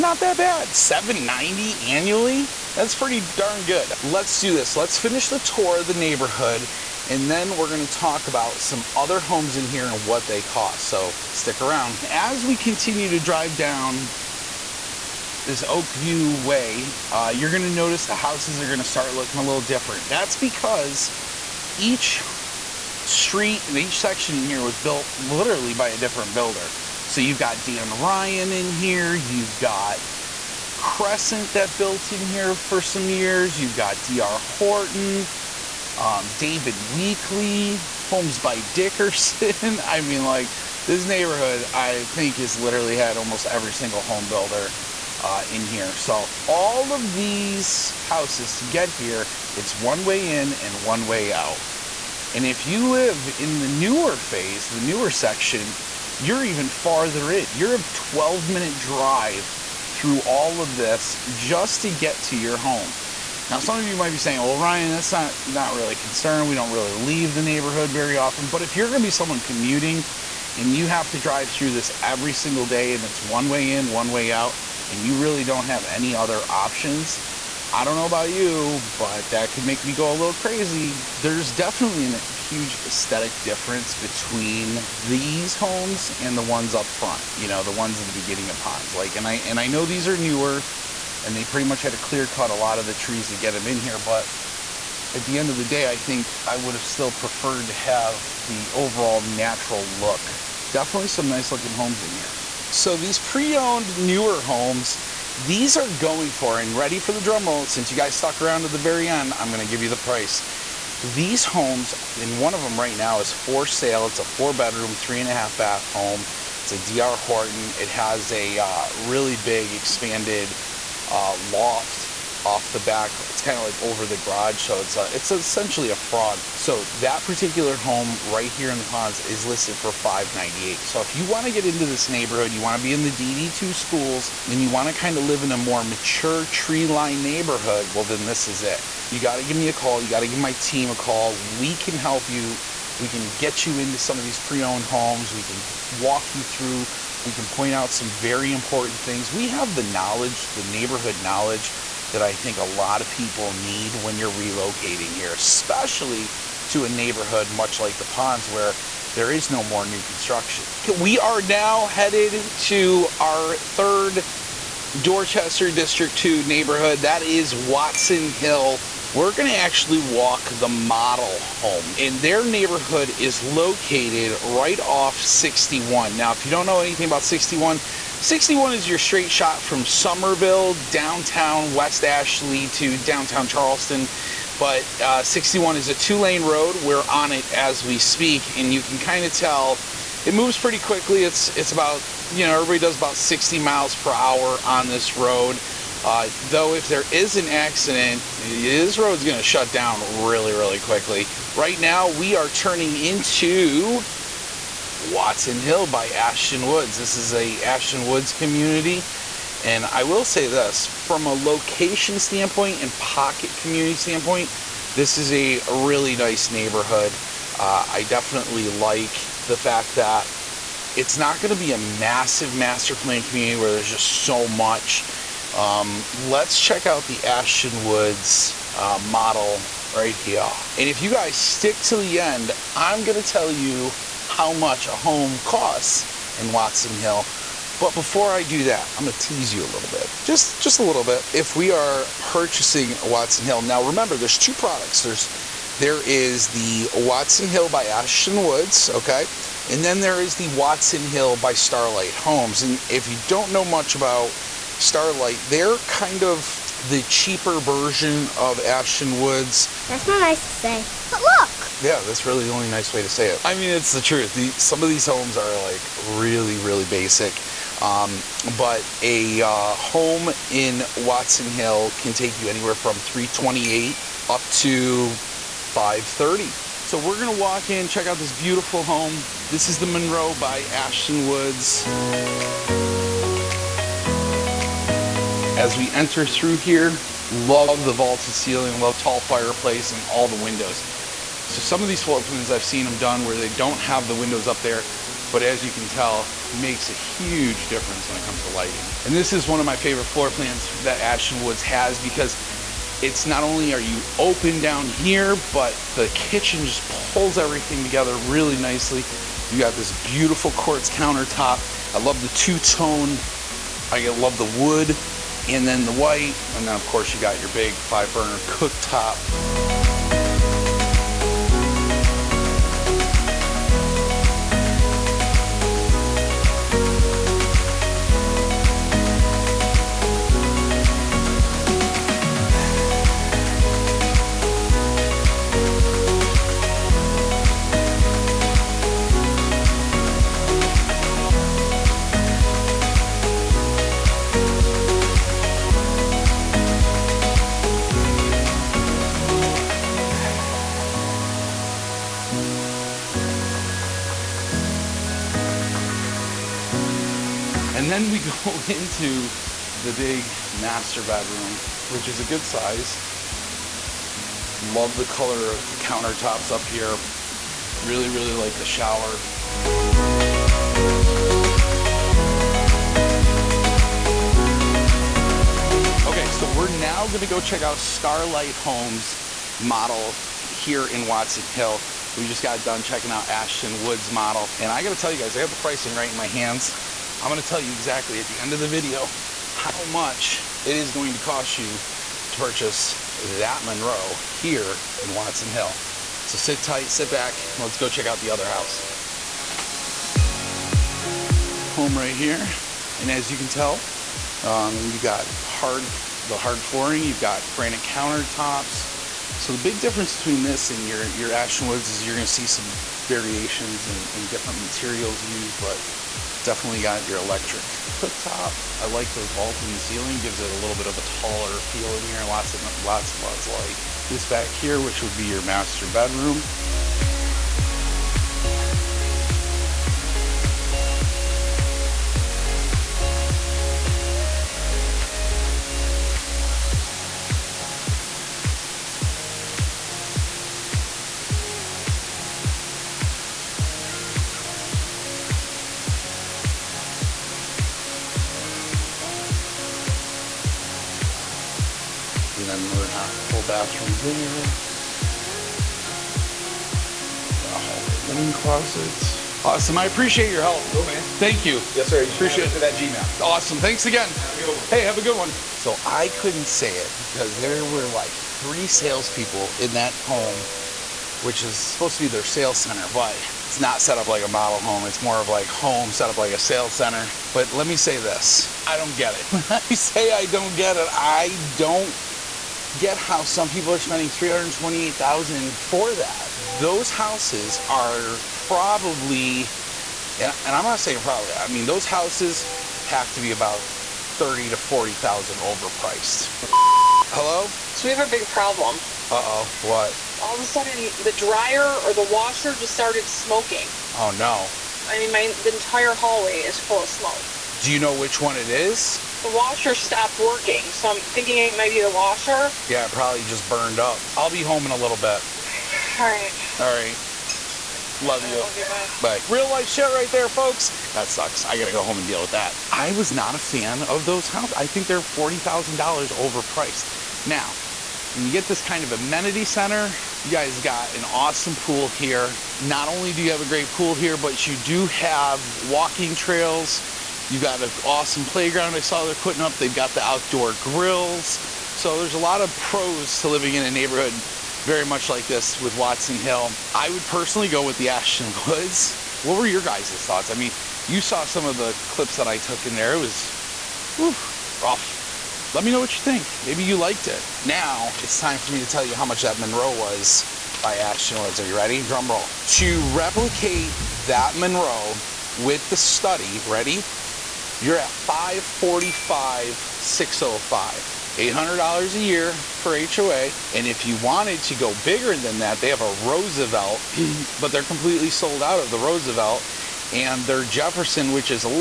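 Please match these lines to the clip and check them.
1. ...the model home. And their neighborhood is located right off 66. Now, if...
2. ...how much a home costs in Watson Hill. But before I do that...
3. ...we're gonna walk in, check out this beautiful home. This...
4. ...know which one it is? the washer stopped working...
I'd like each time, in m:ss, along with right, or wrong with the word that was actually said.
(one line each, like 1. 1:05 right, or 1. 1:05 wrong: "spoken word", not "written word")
1. 2:50 wrong: "61", not "66"
2. 3:54 right
3. 4:36 right
4. 8:27 right.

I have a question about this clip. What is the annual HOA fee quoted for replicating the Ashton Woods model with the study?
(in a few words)
$800.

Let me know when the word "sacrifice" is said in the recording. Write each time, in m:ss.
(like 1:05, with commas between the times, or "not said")
not said.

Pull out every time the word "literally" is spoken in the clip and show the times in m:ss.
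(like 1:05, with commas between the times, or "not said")
0:25, 0:42.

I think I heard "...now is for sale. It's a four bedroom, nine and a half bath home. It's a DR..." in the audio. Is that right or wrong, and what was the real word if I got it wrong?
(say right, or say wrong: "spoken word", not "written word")
wrong: "three", not "nine".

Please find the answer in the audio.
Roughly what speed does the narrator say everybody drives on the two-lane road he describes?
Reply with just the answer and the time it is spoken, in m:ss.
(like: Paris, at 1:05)
60 miles per hour, at 3:13.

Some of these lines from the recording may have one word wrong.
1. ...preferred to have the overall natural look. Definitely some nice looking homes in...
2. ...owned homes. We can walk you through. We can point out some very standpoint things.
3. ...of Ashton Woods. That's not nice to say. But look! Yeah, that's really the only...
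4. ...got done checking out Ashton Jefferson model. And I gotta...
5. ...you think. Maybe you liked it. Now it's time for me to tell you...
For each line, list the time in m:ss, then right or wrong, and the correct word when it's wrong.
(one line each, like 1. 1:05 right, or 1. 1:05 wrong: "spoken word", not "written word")
1. 1:37 right
2. 2:24 wrong: "important", not "standpoint"
3. 4:18 right
4. 6:22 wrong: "Woods", not "Jefferson"
5. 9:15 right.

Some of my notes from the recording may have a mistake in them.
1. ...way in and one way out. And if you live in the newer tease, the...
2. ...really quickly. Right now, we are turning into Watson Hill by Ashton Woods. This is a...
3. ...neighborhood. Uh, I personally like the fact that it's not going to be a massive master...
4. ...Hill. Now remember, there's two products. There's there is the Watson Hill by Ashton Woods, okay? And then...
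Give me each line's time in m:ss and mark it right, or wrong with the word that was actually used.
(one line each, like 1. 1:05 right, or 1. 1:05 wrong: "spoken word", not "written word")
1. 0:50 wrong: "phase", not "tease"
2. 3:20 right
3. 3:36 wrong: "definitely", not "personally"
4. 4:03 right.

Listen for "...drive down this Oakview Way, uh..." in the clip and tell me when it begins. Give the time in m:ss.
0:13.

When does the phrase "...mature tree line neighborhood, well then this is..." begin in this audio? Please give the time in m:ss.
2:15.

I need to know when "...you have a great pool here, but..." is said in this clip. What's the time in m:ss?
8:53.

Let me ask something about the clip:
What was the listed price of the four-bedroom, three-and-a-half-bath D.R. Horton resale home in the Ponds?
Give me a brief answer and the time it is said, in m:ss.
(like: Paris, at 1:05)
598, at 2:09.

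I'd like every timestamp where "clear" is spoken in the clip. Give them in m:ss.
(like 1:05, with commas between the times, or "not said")
1:31.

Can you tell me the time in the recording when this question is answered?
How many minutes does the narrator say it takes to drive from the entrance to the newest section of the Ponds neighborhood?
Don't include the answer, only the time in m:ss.
0:57.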